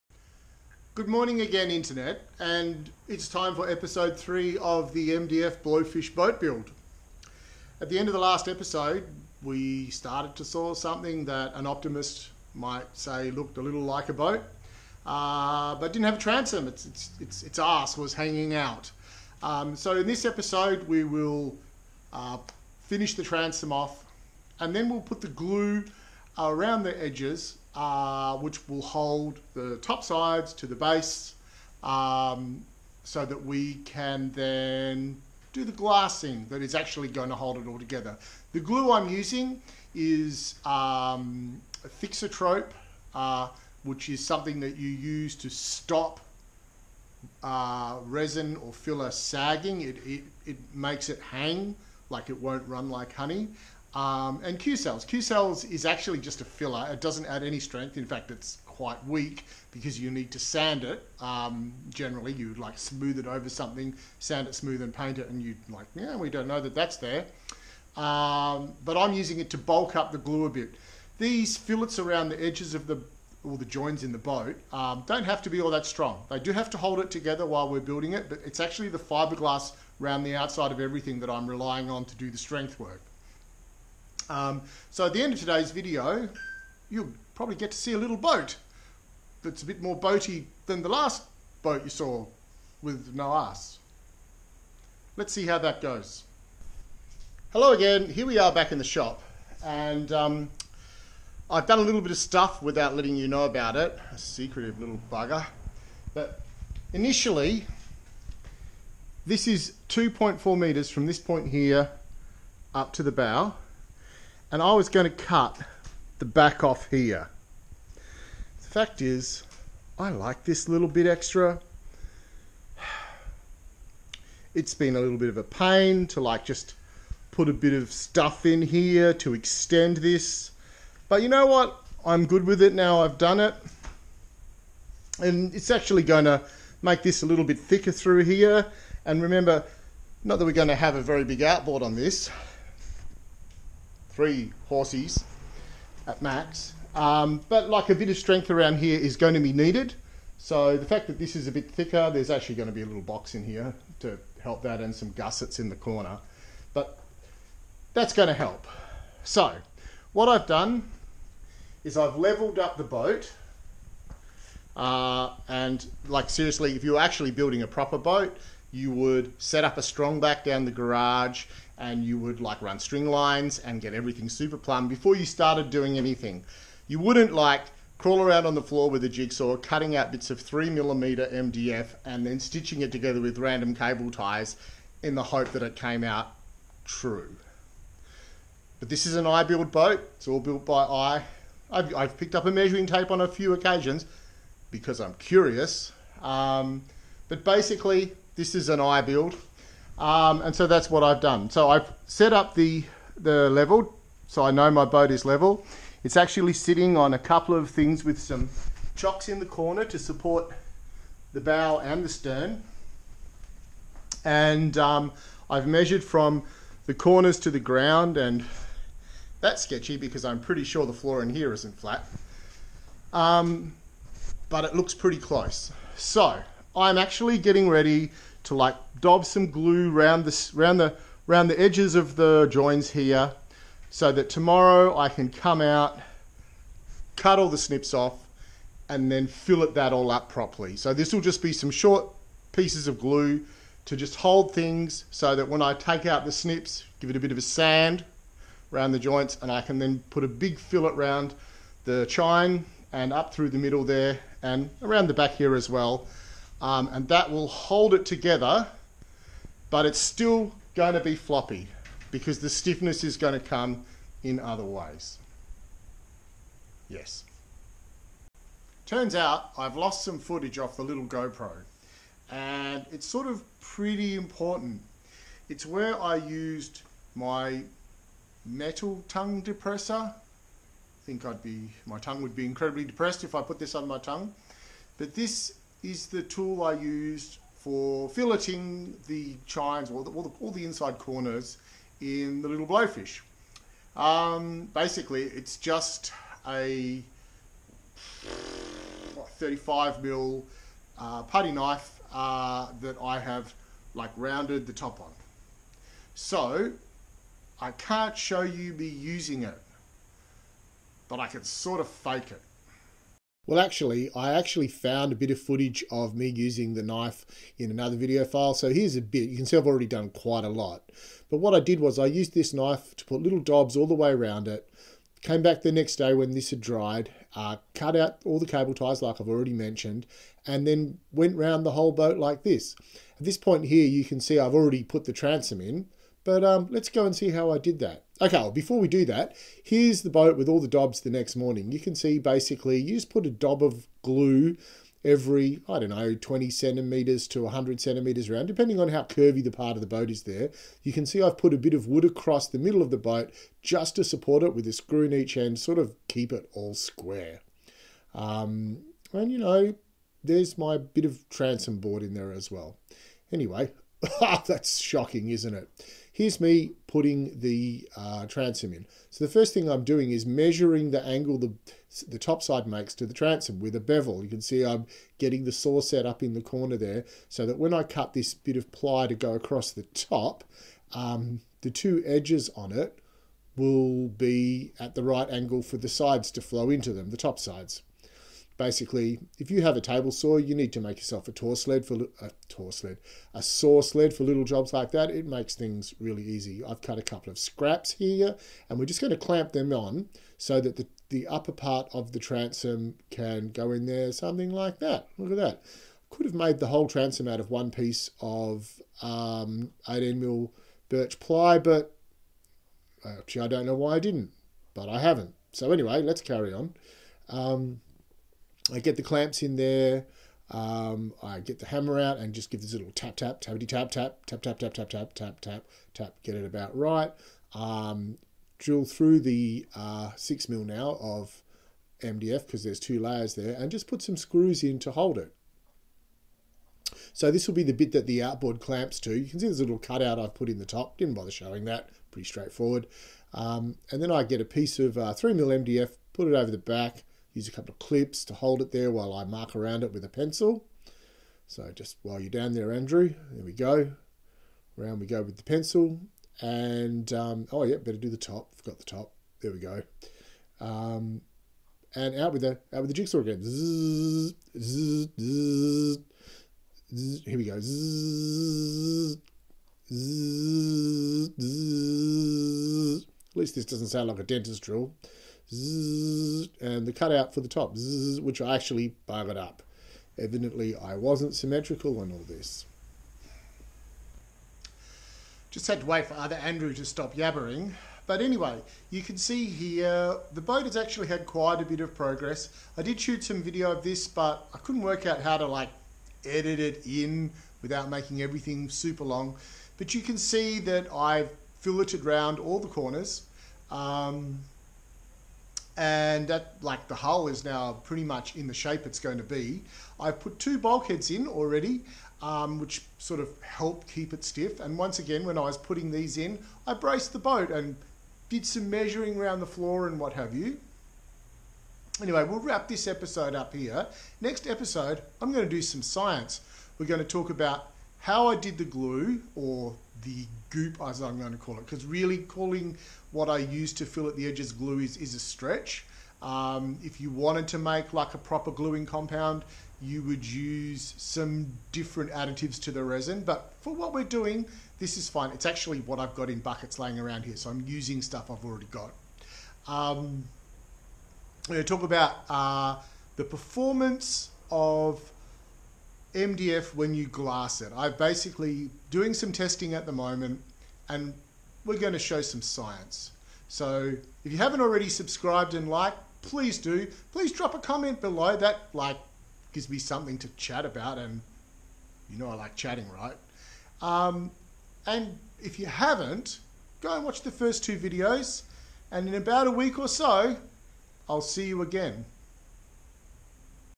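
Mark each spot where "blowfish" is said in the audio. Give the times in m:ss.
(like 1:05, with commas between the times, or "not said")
0:05, 4:52.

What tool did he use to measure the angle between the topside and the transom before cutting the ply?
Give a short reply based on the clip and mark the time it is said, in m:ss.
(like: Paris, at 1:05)
A bevel, at 6:13.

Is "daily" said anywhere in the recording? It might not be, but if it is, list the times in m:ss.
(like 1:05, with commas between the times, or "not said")
not said.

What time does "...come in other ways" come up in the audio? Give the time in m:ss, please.
4:23.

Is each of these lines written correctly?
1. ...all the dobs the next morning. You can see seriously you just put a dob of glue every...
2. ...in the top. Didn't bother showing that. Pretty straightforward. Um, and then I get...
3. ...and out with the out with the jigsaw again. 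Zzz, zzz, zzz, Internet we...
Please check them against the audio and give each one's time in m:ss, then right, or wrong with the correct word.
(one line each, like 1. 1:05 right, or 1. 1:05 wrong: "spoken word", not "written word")
1. 5:40 wrong: "basically", not "seriously"
2. 7:20 right
3. 7:41 wrong: "Here", not "Internet".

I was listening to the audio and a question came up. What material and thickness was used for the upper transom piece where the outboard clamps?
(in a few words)
18 mil birch ply.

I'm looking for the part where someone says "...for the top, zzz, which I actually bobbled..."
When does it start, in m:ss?
7:57.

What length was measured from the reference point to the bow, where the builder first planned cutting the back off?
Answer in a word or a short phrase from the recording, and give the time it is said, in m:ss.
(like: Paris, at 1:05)
2.4 meters, at 1:49.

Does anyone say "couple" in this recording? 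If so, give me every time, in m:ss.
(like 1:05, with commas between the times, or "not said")
3:27, 6:37, 7:27.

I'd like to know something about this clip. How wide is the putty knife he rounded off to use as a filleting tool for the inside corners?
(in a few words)
35 mil.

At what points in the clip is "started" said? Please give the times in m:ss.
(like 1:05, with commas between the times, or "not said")
0:09, 2:55.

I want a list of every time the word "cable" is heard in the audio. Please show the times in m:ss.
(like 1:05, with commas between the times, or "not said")
3:03, 5:28.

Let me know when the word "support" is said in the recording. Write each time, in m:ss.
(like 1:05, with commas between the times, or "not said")
3:29, 5:54.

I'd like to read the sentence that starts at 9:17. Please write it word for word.
I'm basically doing some testing at the moment and we're going to show some science.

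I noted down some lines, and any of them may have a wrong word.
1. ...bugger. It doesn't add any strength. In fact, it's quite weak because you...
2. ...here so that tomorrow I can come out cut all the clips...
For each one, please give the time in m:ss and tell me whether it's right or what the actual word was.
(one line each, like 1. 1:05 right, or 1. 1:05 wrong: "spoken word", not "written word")
1. 0:56 wrong: "filler", not "bugger"
2. 3:52 wrong: "snips", not "clips".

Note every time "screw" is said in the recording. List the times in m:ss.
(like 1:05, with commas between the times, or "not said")
5:54, 7:14.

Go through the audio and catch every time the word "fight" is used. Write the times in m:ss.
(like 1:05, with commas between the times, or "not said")
not said.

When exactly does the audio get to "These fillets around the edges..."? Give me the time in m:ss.
1:11.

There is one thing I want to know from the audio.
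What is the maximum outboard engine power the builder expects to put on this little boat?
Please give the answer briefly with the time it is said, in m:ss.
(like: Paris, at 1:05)
3 horses, at 2:24.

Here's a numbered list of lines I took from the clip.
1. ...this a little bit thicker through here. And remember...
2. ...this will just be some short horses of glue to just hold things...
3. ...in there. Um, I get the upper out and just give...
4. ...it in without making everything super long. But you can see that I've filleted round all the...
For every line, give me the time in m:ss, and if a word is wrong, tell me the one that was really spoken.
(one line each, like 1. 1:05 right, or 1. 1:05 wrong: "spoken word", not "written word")
1. 2:17 right
2. 4:00 wrong: "pieces", not "horses"
3. 6:59 wrong: "hammer", not "upper"
4. 8:16 right.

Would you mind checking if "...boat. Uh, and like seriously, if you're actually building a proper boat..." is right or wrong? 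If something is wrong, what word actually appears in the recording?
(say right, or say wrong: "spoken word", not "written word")
right.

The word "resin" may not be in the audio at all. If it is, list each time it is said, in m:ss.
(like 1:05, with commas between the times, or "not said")
0:48, 9:02.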